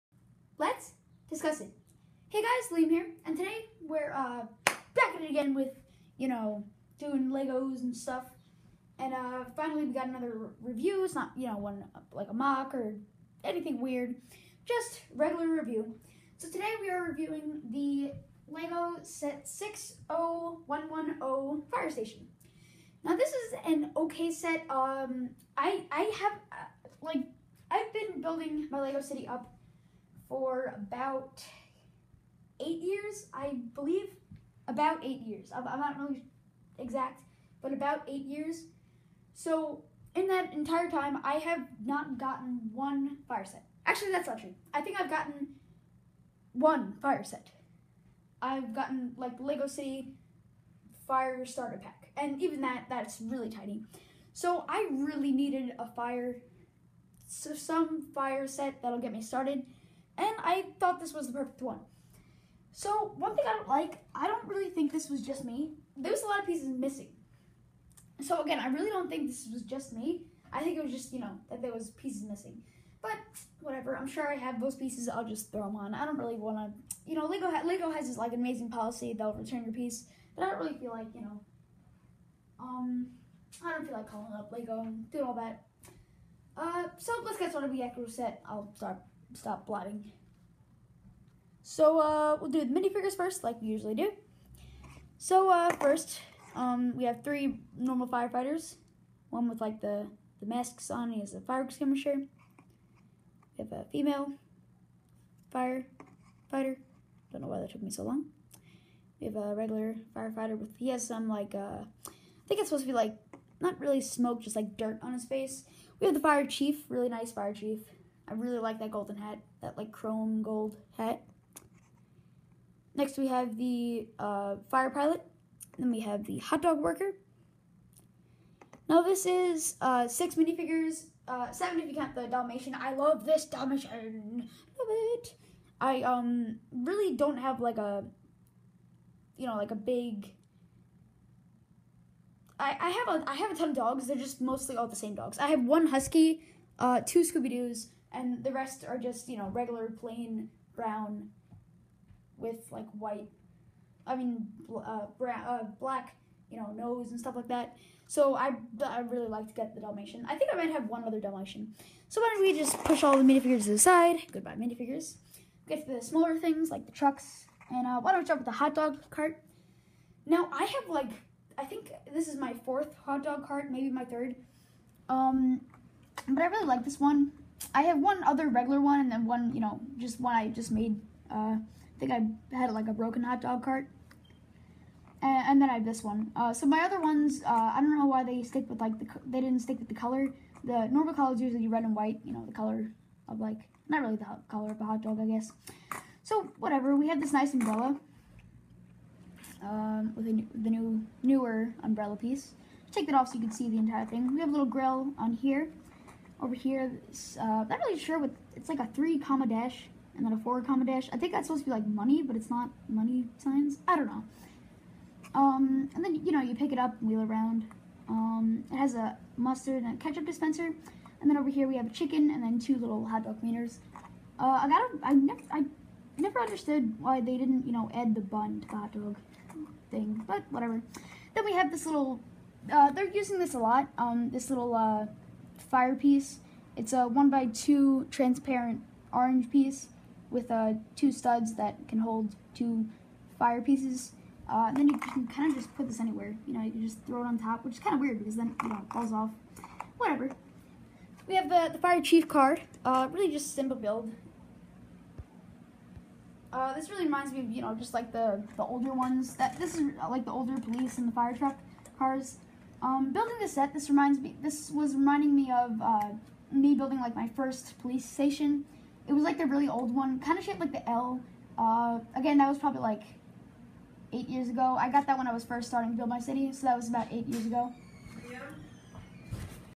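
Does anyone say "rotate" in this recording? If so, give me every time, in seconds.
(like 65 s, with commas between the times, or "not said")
not said.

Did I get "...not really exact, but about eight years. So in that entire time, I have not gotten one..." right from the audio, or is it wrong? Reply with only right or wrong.
right.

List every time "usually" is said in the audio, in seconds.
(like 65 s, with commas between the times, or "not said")
93 s, 191 s.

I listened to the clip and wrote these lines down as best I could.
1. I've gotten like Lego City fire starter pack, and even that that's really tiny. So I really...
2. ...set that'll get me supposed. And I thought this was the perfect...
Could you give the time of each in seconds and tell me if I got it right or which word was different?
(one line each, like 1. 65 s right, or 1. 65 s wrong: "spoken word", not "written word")
1. 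48 s right
2. 58 s wrong: "started", not "supposed".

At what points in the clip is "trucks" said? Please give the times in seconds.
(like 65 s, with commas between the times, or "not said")
166 s, 261 s.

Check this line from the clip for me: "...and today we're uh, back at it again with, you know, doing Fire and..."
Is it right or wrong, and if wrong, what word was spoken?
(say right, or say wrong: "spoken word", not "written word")
wrong: "Legos", not "Fire".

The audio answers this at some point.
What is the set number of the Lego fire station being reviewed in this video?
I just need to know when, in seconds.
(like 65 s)
19 s.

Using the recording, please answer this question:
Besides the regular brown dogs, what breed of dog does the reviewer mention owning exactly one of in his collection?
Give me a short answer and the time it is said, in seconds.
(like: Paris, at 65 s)
Husky, at 145 s.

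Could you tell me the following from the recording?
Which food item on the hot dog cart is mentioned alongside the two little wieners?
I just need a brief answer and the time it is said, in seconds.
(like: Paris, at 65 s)
A chicken, at 221 s.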